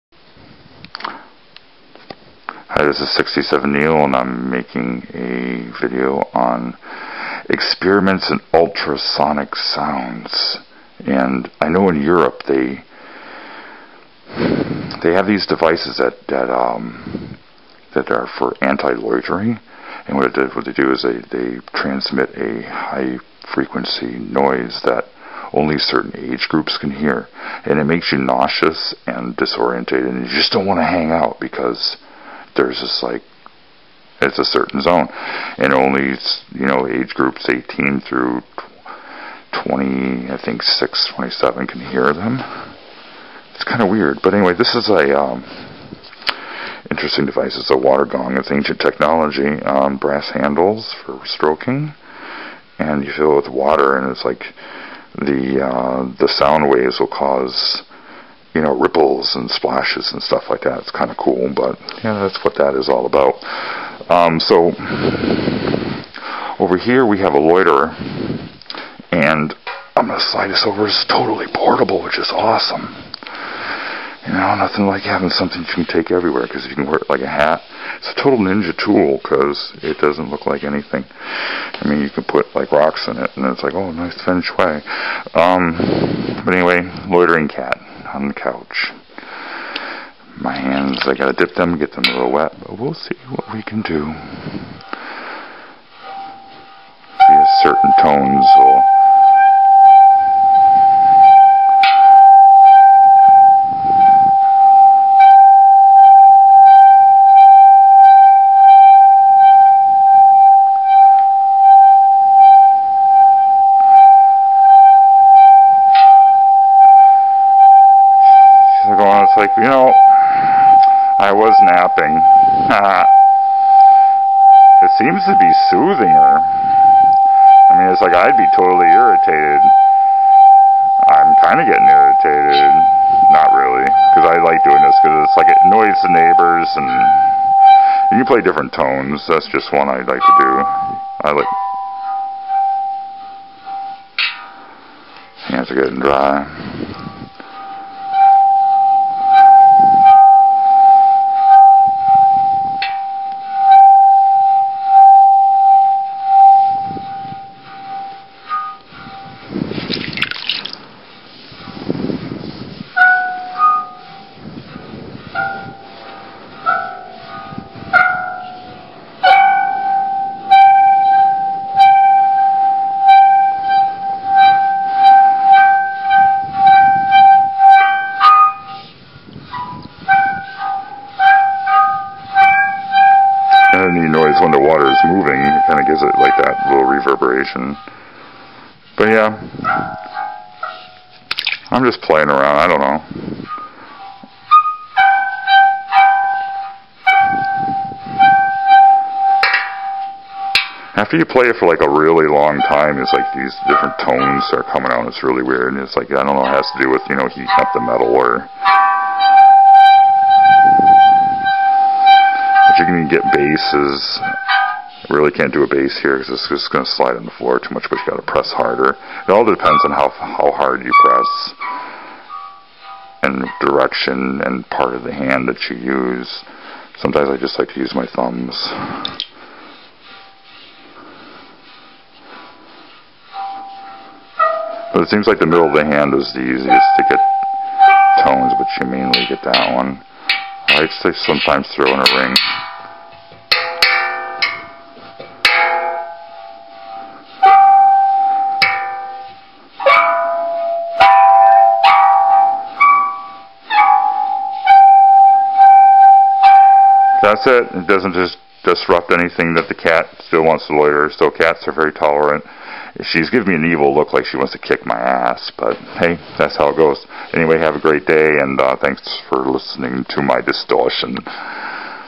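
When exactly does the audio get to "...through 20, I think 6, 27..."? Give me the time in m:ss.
0:38.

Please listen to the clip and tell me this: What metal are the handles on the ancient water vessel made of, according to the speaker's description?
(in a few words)
Brass.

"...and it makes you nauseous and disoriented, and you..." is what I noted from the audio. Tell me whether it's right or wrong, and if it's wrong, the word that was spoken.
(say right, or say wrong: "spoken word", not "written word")
right.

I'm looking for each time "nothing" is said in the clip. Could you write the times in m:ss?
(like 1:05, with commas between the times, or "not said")
1:14.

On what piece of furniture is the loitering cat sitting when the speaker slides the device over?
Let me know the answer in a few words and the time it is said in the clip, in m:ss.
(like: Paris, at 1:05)
The couch, at 1:28.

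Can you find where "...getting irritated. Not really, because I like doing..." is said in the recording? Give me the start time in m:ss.
2:11.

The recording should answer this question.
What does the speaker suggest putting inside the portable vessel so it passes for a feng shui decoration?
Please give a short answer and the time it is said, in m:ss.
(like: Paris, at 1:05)
Rocks, at 1:22.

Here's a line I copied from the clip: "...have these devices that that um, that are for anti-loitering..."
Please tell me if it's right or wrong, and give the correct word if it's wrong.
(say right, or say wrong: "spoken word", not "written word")
right.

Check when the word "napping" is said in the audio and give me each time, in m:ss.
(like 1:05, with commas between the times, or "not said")
2:01.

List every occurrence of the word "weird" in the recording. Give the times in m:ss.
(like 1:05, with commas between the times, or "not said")
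0:43, 3:25.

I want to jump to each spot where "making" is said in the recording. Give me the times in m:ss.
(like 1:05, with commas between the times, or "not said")
0:04.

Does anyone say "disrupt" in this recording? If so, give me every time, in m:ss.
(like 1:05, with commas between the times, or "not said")
4:18.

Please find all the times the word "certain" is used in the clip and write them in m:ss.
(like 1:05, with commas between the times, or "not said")
0:25, 0:34, 1:37.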